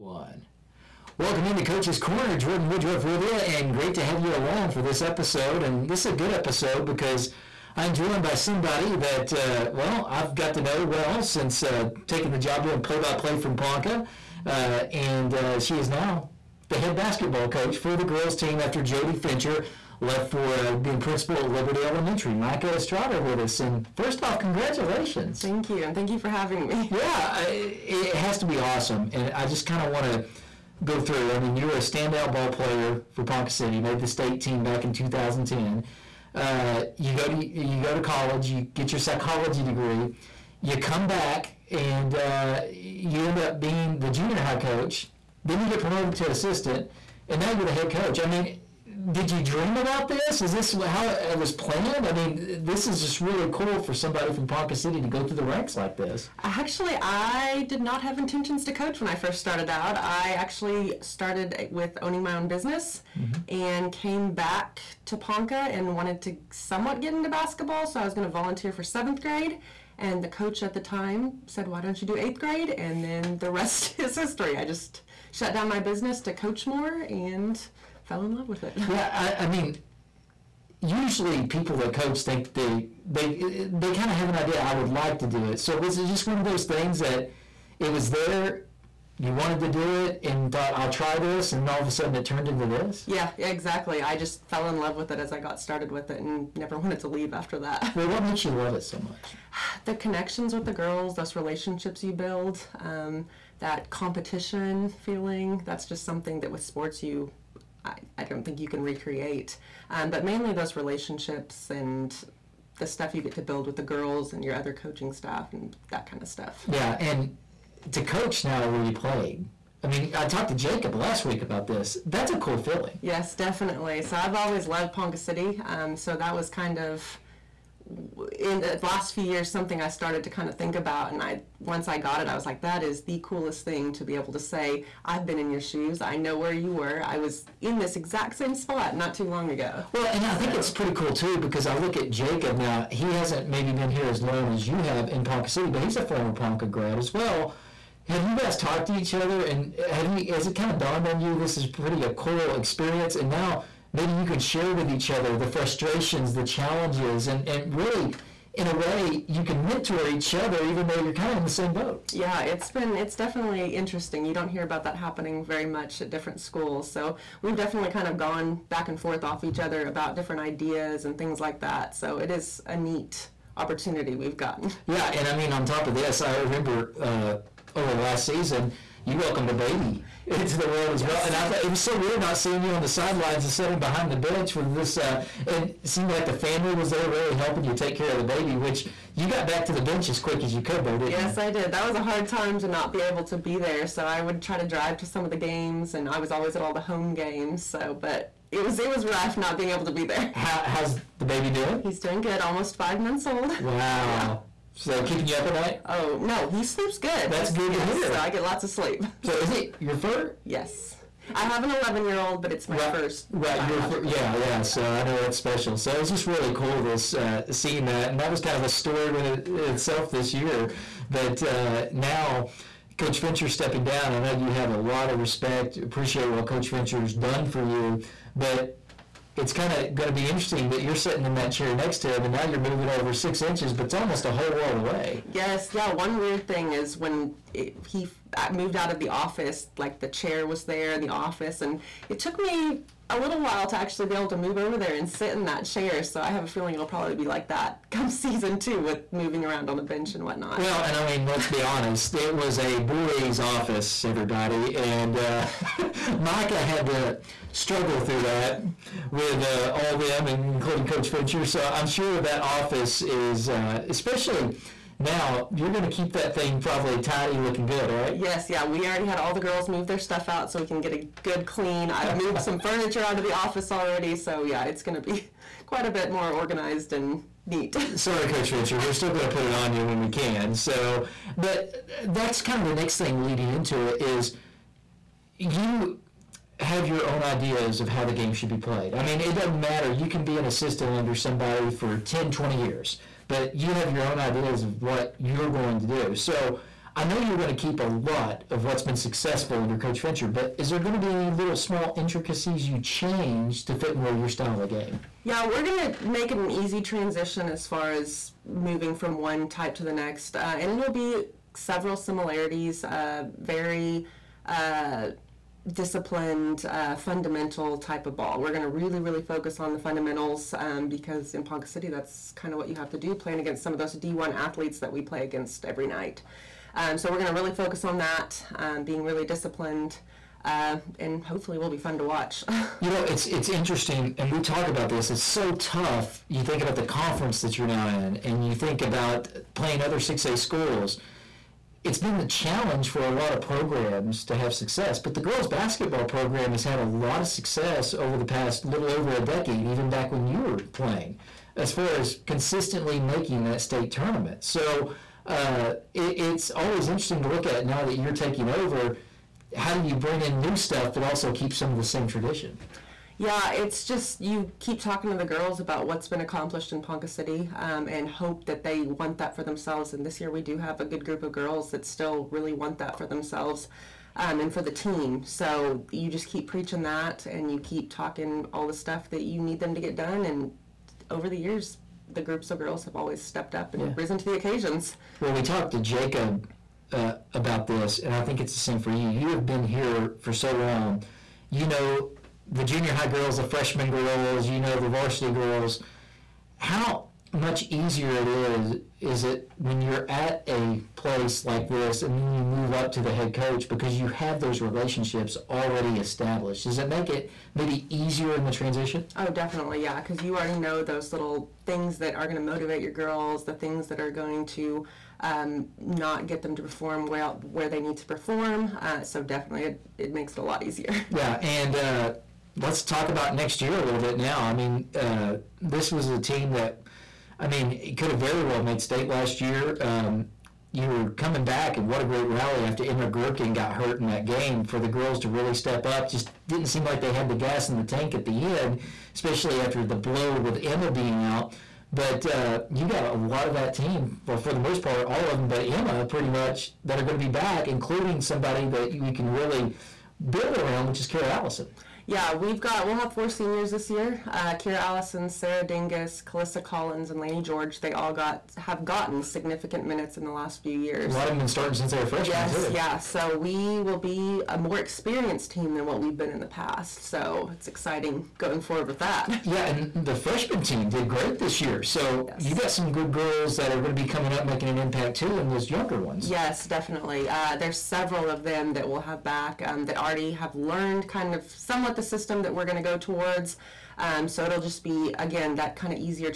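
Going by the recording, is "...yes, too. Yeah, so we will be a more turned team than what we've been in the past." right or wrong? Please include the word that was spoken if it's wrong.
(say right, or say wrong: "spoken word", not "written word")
wrong: "experienced", not "turned".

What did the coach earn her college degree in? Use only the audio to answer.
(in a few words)
Psychology.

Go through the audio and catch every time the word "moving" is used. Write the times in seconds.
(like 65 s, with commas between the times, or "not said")
232 s, 249 s, 308 s.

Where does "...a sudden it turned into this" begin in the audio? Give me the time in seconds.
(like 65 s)
91 s.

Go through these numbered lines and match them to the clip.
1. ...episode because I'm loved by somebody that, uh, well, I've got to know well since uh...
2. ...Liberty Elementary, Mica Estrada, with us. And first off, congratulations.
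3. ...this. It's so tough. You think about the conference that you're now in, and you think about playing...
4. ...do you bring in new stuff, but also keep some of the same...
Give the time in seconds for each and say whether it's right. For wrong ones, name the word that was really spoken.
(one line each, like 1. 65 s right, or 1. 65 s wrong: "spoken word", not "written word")
1. 6 s wrong: "joined", not "loved"
2. 21 s right
3. 334 s right
4. 359 s right.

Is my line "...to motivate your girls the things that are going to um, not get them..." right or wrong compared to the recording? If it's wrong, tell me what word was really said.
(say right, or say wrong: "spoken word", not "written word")
right.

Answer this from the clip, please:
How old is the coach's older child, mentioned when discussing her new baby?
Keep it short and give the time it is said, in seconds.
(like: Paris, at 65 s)
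11, at 211 s.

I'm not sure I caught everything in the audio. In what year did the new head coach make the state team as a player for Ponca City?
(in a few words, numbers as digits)
2010.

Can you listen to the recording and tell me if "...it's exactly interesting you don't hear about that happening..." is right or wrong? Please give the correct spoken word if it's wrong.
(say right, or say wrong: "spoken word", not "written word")
wrong: "definitely", not "exactly".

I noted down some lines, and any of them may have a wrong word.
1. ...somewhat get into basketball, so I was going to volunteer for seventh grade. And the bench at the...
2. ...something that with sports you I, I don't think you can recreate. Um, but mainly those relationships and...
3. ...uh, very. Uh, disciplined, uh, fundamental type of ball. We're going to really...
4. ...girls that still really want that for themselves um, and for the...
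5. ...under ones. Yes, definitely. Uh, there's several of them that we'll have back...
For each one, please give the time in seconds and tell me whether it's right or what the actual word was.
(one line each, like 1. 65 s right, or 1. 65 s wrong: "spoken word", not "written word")
1. 66 s wrong: "coach", not "bench"
2. 106 s right
3. 312 s right
4. 371 s right
5. 475 s wrong: "younger", not "under".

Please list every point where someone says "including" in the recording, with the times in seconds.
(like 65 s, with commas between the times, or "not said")
260 s, 447 s.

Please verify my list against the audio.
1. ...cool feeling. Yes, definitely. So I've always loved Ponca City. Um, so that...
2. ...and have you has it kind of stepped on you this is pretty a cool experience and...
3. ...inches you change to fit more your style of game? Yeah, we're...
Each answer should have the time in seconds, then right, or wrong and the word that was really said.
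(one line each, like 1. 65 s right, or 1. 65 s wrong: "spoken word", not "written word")
1. 122 s right
2. 149 s wrong: "dawned", not "stepped"
3. 301 s wrong: "intricacies", not "inches".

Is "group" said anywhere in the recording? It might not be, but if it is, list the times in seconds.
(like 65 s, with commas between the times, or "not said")
371 s, 382 s.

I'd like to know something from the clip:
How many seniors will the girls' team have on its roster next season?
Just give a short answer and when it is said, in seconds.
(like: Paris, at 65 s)
4, at 453 s.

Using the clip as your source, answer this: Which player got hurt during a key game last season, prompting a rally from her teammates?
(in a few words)
Emma Gherkin.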